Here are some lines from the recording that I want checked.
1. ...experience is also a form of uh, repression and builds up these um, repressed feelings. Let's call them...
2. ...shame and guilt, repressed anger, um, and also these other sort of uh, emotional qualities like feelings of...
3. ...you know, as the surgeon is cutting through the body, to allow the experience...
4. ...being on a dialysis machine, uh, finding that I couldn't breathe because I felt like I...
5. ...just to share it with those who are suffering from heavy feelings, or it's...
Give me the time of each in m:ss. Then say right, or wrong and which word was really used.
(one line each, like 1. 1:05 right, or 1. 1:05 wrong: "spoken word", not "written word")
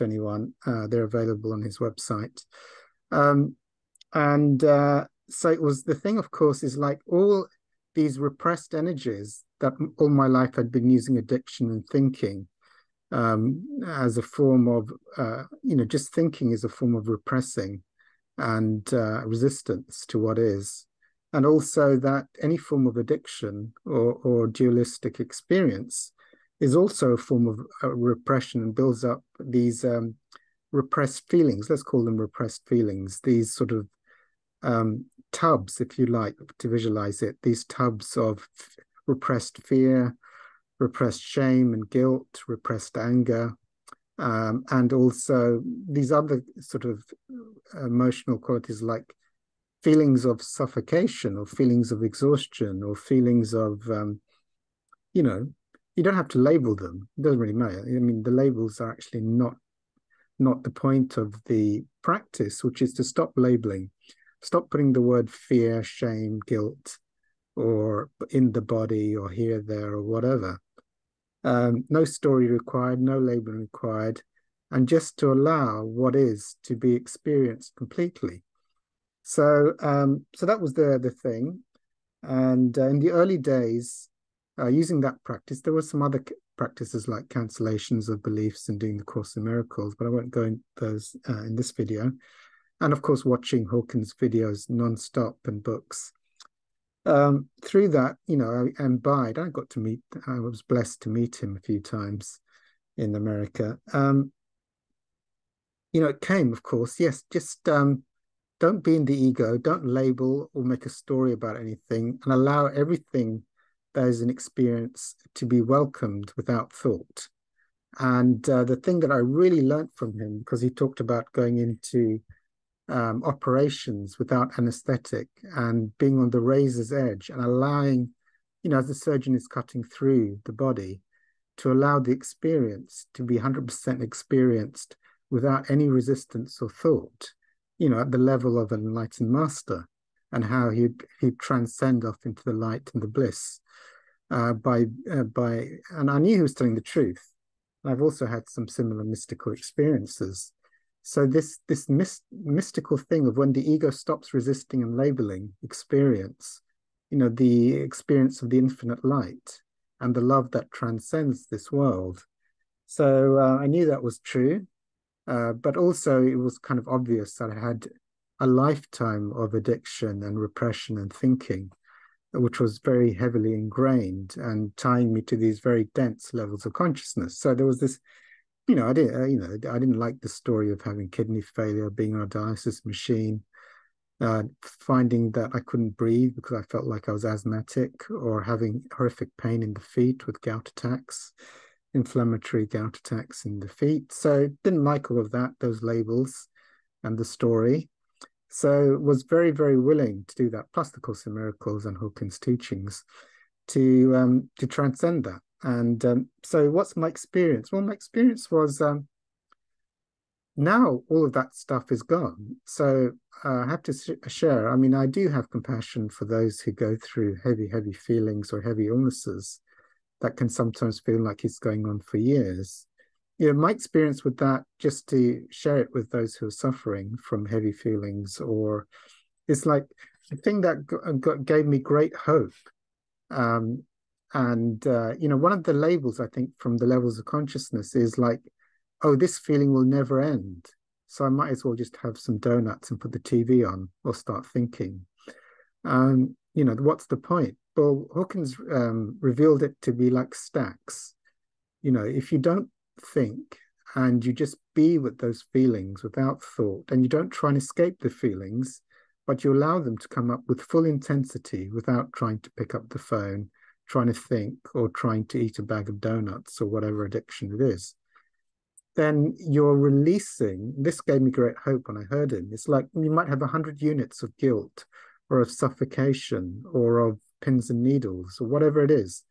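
1. 0:25 right
2. 0:41 right
3. 2:08 right
4. 3:01 right
5. 3:44 right.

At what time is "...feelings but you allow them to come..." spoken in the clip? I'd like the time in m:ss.
4:18.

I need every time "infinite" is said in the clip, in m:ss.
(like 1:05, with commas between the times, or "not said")
2:38.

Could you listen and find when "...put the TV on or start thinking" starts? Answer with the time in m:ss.
4:02.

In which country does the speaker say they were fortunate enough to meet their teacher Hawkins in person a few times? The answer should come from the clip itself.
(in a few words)
America.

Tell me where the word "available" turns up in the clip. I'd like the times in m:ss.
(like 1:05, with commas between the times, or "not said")
0:01.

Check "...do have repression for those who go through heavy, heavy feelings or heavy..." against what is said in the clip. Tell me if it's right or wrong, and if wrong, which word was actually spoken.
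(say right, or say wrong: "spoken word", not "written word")
wrong: "compassion", not "repression".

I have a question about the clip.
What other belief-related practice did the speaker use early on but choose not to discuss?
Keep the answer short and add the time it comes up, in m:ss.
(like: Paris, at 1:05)
Cancellations of beliefs, at 1:27.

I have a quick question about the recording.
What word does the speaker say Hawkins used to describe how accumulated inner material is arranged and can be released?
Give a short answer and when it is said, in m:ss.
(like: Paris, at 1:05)
Stacks, at 4:10.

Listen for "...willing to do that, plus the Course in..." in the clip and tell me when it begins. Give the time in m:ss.
3:19.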